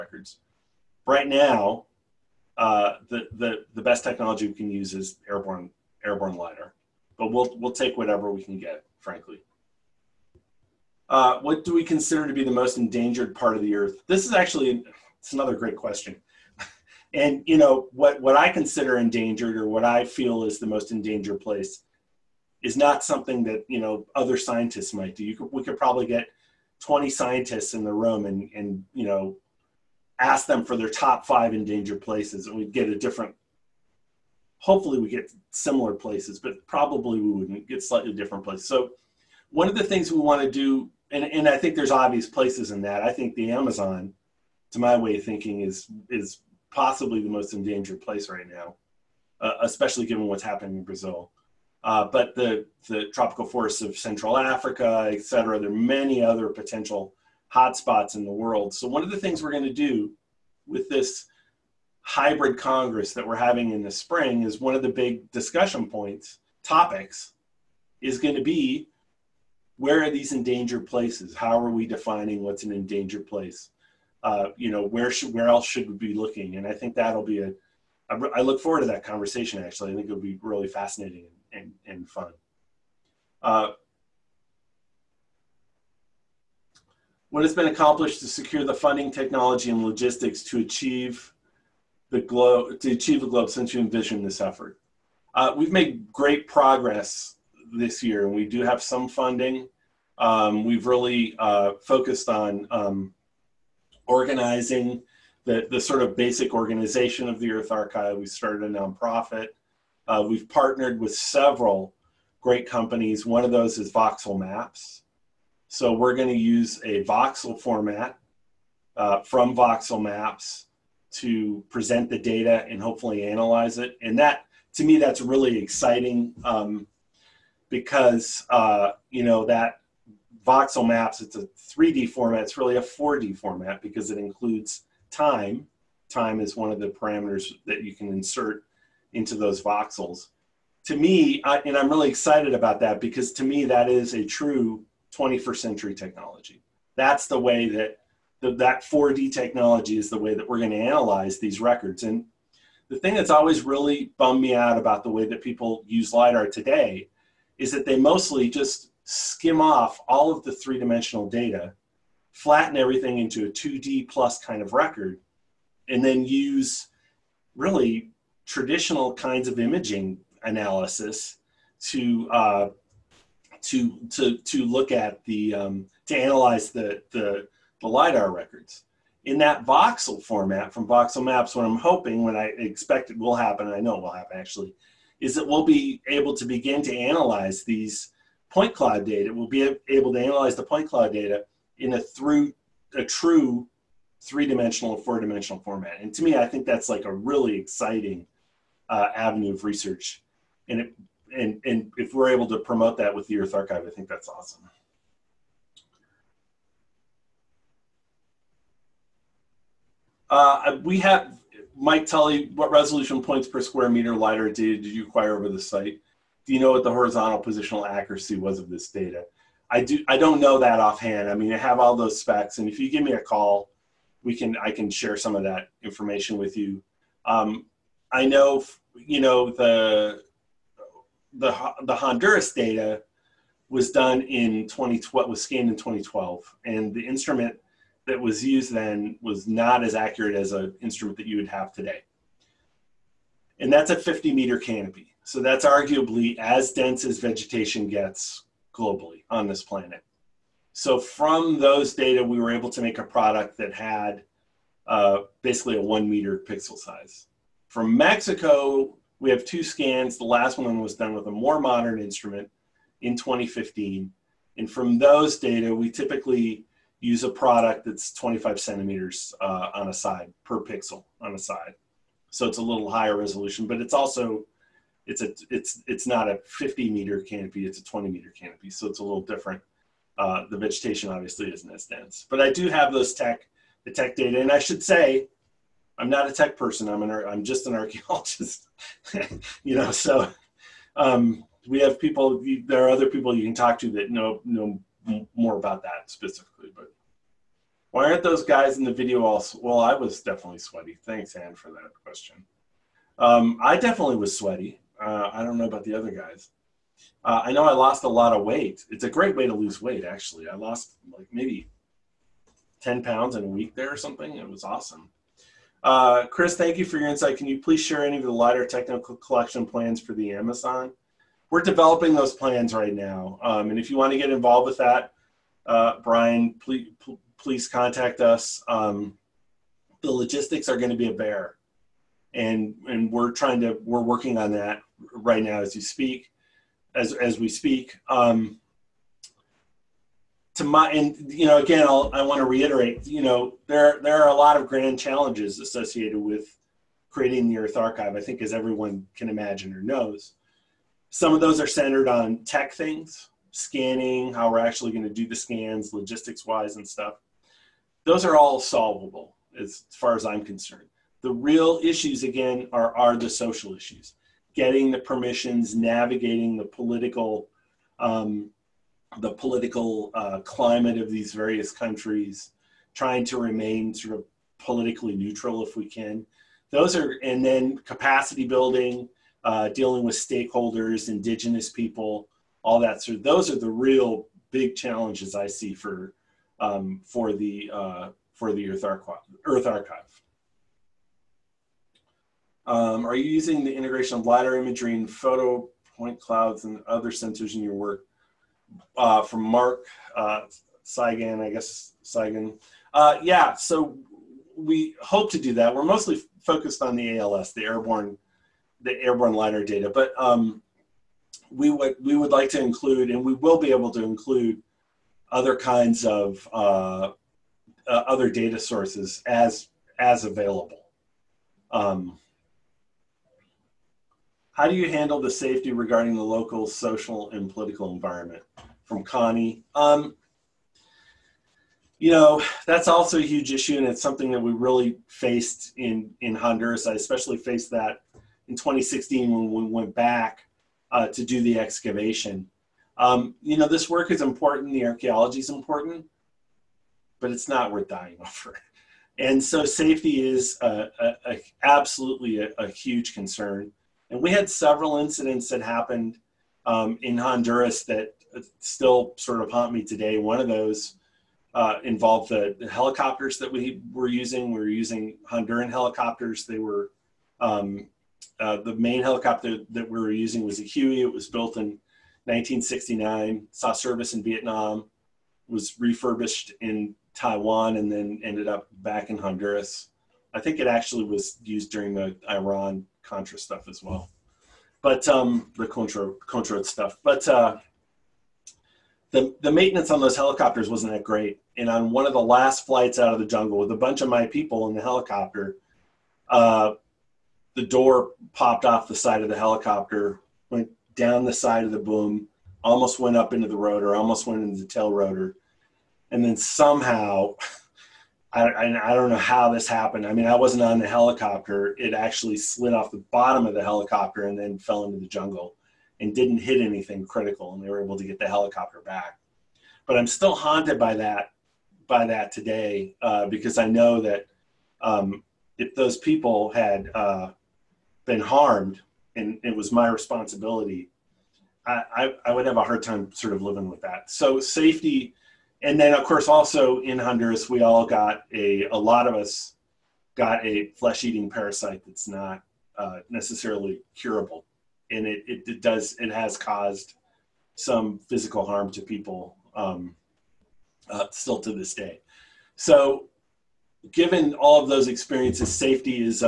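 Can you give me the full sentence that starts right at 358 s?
Those are all solvable as far as I'm concerned.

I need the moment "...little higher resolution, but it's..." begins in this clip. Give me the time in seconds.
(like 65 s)
272 s.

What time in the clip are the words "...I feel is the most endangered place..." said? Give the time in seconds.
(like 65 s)
19 s.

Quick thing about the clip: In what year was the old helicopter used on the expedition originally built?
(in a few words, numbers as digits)
1969.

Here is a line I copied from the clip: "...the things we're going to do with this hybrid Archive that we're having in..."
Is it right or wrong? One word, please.
wrong.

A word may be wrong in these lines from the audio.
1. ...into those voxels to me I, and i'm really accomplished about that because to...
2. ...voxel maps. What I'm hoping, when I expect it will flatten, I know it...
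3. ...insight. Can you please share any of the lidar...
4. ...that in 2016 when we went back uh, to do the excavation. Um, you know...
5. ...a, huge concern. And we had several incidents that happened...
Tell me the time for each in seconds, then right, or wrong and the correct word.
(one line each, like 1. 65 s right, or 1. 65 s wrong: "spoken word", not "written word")
1. 139 s wrong: "excited", not "accomplished"
2. 180 s wrong: "happen", not "flatten"
3. 317 s right
4. 437 s right
5. 452 s right.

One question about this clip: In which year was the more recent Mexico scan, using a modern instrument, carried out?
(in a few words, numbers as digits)
2015.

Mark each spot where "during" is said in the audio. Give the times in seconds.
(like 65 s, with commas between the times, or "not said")
481 s.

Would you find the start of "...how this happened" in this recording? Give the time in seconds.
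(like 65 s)
509 s.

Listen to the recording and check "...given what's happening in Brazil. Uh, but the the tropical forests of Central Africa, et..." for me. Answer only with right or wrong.
right.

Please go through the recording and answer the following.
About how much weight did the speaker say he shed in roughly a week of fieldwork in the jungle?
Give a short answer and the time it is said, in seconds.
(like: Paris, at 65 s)
10 pounds, at 312 s.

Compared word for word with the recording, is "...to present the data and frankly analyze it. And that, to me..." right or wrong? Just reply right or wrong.
wrong.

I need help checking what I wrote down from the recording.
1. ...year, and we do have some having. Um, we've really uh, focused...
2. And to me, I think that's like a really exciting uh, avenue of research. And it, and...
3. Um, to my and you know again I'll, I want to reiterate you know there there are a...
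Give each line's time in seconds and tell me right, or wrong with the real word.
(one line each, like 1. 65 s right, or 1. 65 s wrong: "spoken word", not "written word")
1. 98 s wrong: "funding", not "having"
2. 195 s right
3. 338 s right.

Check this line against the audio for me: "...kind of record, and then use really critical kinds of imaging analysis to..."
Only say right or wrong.
wrong.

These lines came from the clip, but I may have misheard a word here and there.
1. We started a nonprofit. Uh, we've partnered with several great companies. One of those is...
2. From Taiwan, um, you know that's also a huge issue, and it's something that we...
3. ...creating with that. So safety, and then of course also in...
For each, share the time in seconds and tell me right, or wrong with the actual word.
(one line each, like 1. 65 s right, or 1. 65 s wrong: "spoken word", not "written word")
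1. 108 s right
2. 428 s wrong: "Connie", not "Taiwan"
3. 533 s wrong: "living", not "creating".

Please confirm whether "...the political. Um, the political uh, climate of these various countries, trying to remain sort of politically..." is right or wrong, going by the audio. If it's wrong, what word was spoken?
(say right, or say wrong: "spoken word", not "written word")
right.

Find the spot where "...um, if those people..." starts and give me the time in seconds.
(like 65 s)
524 s.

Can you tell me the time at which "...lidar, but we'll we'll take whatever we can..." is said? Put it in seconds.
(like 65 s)
6 s.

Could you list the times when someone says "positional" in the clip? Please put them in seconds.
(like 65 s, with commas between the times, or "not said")
217 s.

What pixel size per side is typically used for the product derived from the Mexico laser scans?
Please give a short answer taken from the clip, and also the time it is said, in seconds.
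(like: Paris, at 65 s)
25 centimeters, at 268 s.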